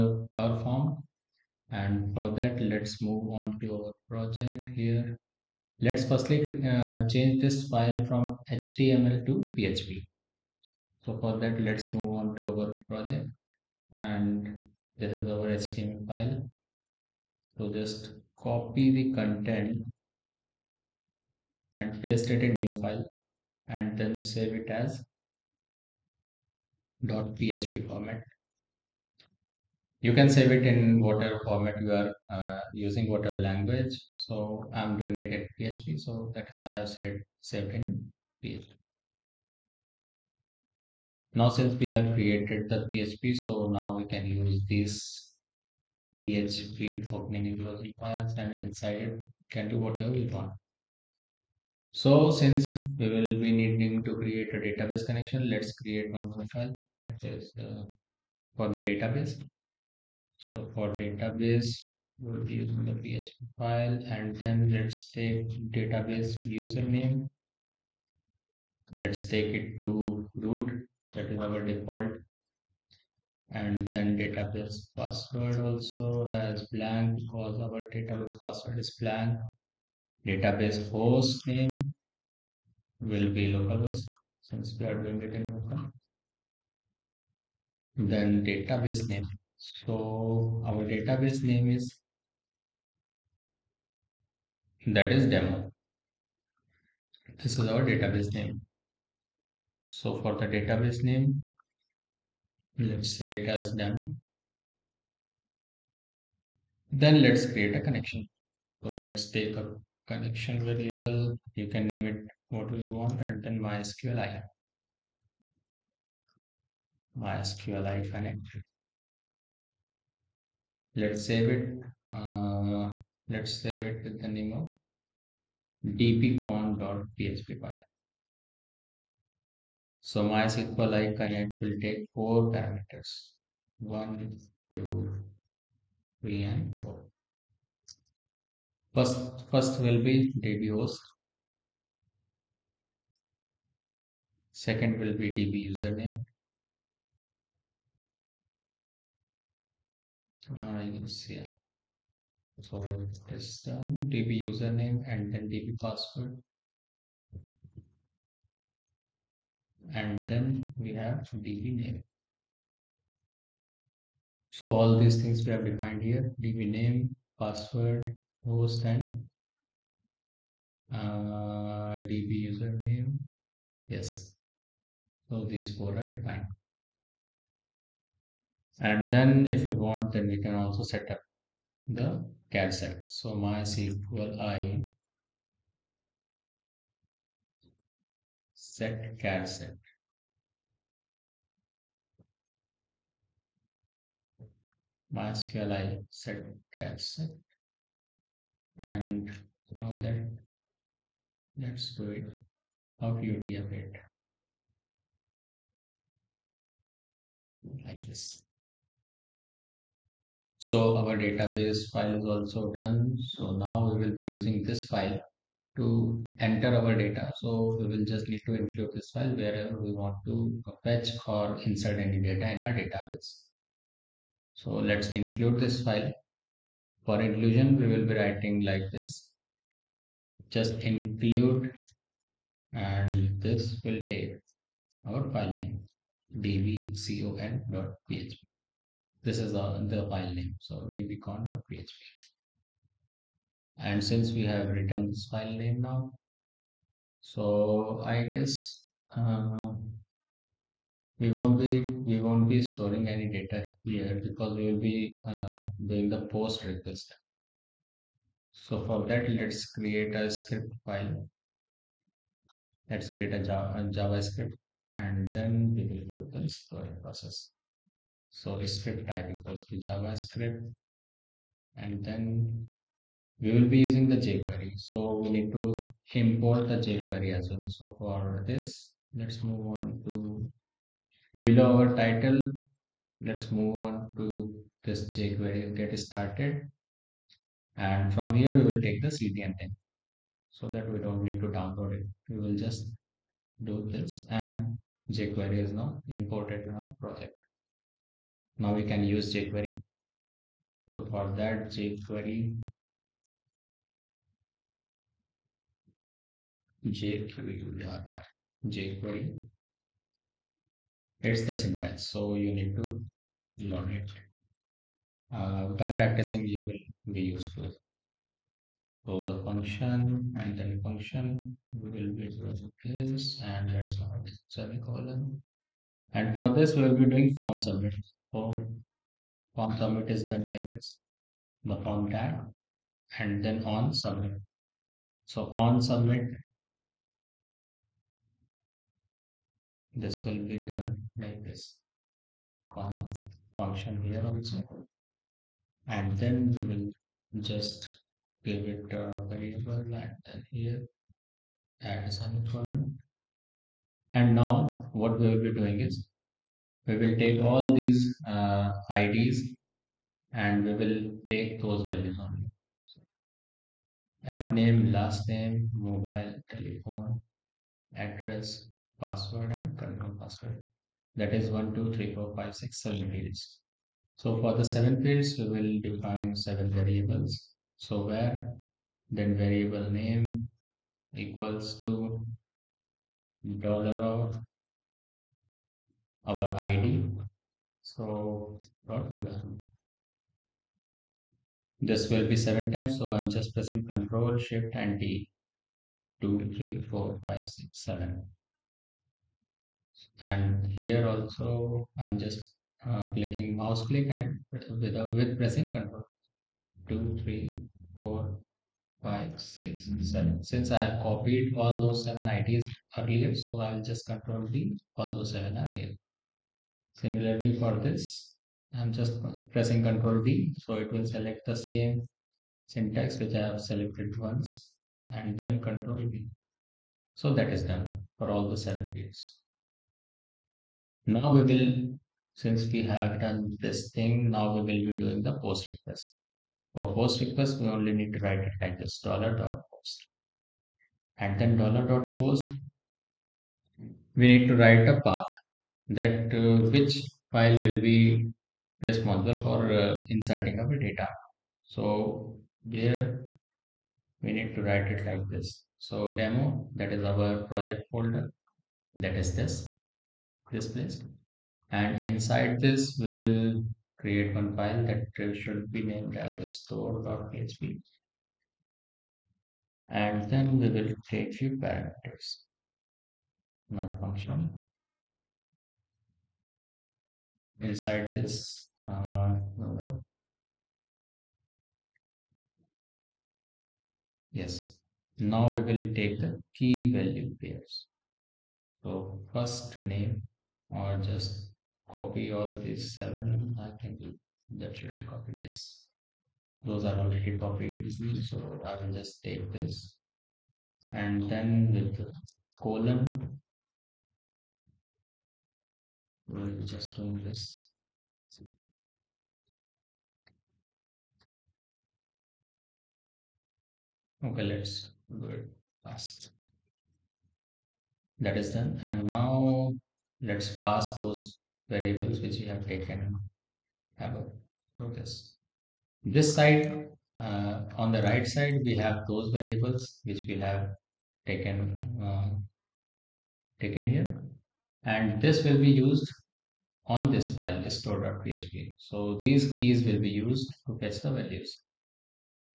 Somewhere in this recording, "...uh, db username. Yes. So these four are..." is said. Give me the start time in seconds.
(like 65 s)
170 s.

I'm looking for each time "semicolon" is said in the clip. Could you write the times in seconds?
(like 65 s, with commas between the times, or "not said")
324 s, 352 s.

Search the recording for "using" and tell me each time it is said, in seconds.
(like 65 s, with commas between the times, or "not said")
32 s, 62 s, 214 s, 273 s.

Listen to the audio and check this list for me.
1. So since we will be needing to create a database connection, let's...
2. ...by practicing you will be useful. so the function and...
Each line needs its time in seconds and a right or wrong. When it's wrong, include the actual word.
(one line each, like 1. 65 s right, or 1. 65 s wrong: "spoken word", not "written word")
1. 51 s right
2. 315 s right.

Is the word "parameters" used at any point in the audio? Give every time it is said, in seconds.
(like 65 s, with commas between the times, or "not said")
132 s, 471 s.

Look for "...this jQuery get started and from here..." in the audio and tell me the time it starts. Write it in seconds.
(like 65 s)
284 s.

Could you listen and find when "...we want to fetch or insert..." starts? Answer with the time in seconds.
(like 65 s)
219 s.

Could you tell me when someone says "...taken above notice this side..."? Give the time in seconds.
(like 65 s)
522 s.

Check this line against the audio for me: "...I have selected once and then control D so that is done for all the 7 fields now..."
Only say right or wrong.
right.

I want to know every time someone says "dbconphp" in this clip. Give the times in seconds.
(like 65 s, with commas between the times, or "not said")
125 s, 236 s, 240 s.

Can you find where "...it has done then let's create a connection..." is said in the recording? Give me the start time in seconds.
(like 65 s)
103 s.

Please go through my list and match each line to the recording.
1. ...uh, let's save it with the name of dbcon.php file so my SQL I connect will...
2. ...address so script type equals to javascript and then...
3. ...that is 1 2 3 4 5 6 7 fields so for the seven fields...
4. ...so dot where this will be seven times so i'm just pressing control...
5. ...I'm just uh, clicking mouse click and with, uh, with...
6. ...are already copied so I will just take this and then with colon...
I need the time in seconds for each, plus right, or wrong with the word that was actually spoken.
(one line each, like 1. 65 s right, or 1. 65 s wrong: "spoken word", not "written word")
1. 122 s right
2. 267 s wrong: "process", not "address"
3. 371 s right
4. 387 s right
5. 401 s right
6. 496 s right.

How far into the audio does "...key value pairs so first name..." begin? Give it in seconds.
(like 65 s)
486 s.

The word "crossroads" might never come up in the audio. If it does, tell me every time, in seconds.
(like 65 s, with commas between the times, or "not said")
not said.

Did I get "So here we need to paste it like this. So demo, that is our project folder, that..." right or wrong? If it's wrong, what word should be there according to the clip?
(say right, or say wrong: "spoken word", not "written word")
wrong: "write", not "paste".